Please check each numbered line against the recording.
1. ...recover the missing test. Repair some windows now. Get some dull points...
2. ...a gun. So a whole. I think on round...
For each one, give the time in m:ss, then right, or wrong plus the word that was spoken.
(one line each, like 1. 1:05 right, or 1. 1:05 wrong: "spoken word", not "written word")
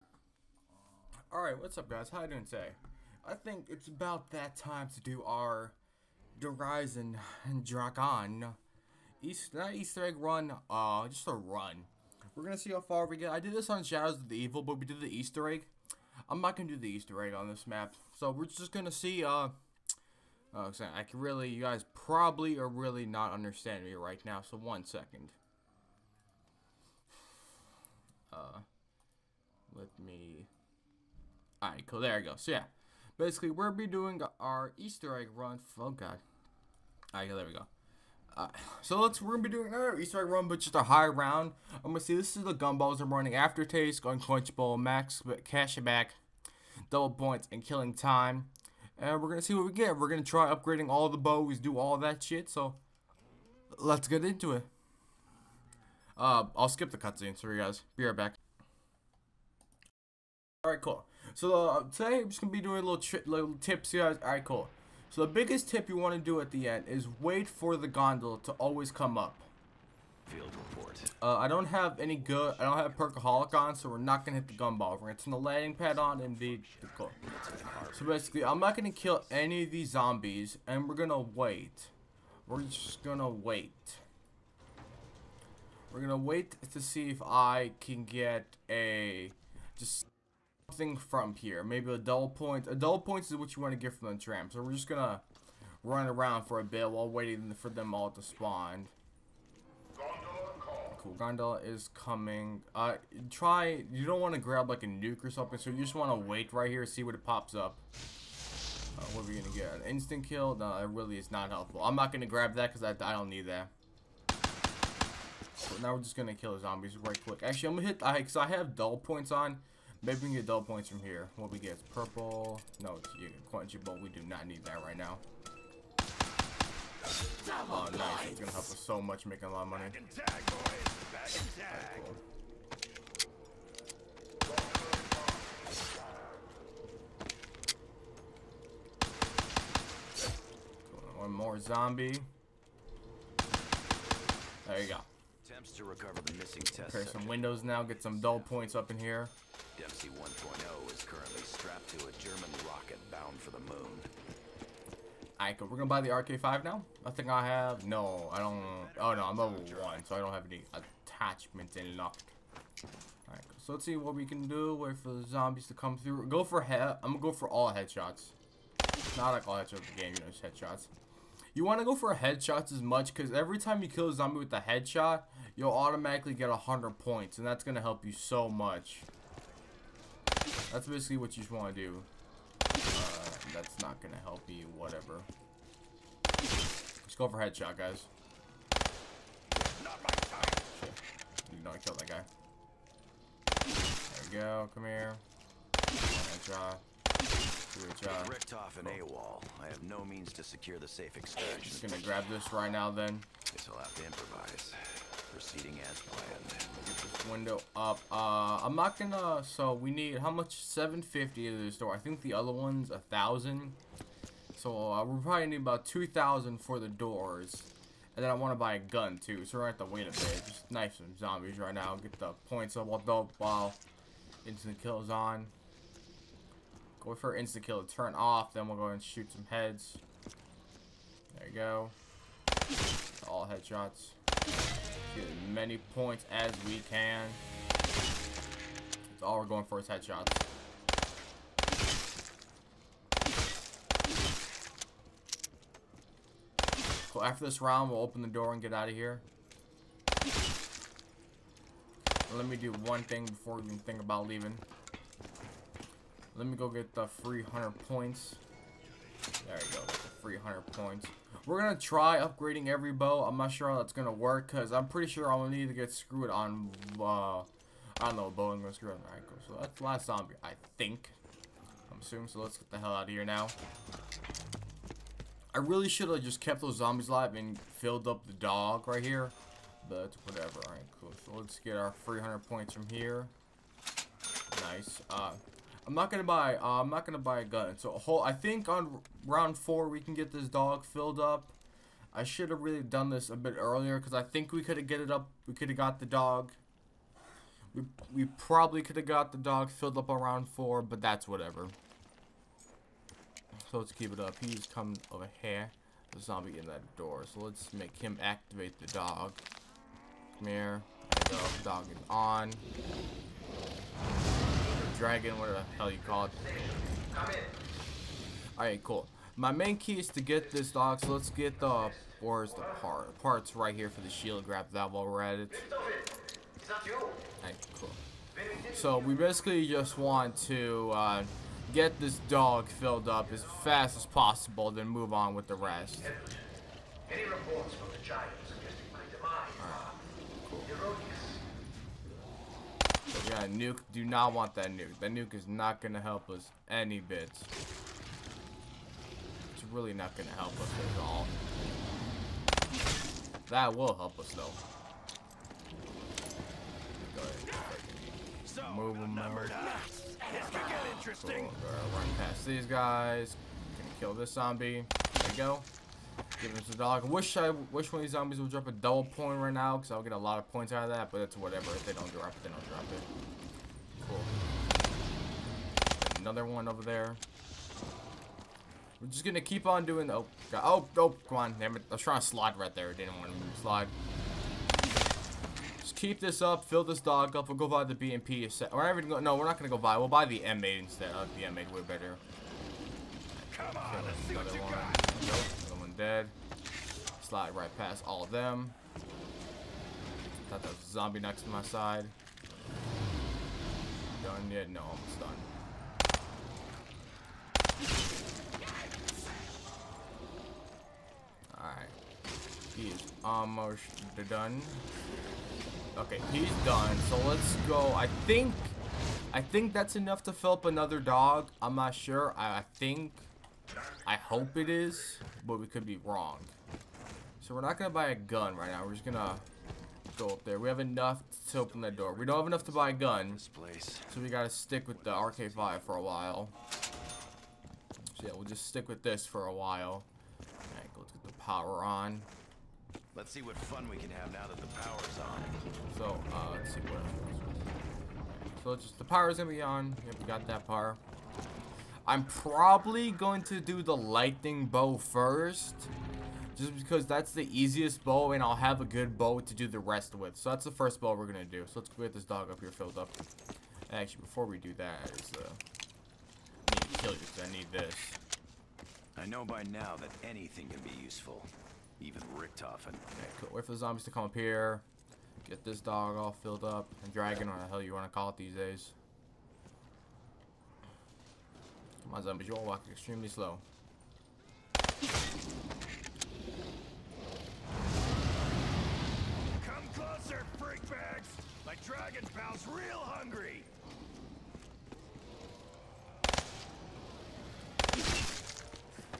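1. 2:25 right
2. 4:47 right.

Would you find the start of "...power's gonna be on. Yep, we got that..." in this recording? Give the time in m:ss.
7:29.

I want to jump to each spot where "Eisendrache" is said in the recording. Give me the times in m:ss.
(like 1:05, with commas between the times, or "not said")
0:06.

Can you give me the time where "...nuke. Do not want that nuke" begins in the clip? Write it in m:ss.
5:43.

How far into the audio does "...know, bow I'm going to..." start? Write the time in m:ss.
4:28.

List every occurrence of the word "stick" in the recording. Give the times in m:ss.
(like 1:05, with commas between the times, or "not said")
7:14, 7:18.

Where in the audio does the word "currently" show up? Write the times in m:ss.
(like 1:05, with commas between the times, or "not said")
2:31.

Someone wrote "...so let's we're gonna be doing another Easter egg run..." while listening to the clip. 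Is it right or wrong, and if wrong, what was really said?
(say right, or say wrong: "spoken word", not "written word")
right.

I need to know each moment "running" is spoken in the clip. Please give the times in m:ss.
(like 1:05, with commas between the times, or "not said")
0:43.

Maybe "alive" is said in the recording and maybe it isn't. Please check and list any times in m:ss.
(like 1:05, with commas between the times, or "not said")
4:37.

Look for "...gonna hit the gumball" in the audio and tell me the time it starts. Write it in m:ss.
1:14.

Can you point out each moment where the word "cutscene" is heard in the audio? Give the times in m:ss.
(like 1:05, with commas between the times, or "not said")
0:56.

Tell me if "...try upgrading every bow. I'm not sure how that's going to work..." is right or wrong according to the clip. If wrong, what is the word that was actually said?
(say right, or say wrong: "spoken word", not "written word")
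right.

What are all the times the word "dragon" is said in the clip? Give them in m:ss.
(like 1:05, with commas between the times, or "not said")
5:15, 7:57, 8:11.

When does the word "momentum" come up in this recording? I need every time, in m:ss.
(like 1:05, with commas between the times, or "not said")
not said.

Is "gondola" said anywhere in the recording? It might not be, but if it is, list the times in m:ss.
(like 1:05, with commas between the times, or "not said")
1:07, 1:41.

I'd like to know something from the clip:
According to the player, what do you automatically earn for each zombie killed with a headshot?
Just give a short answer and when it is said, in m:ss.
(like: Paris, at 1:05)
100 points, at 2:56.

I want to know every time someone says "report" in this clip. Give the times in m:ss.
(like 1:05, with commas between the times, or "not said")
1:10, 5:37.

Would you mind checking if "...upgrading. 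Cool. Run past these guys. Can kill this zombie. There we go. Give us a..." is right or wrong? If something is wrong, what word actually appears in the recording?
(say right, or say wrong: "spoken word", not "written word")
wrong: "interesting", not "upgrading".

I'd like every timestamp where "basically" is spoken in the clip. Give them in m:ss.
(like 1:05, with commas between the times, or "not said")
0:33, 1:18, 3:00, 5:29.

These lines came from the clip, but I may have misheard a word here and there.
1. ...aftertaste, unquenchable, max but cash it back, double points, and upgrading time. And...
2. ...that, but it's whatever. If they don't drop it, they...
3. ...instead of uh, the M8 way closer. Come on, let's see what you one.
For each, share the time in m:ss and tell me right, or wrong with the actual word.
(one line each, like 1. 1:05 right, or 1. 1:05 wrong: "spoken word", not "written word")
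1. 0:43 wrong: "killing", not "upgrading"
2. 6:10 right
3. 6:30 wrong: "better", not "closer".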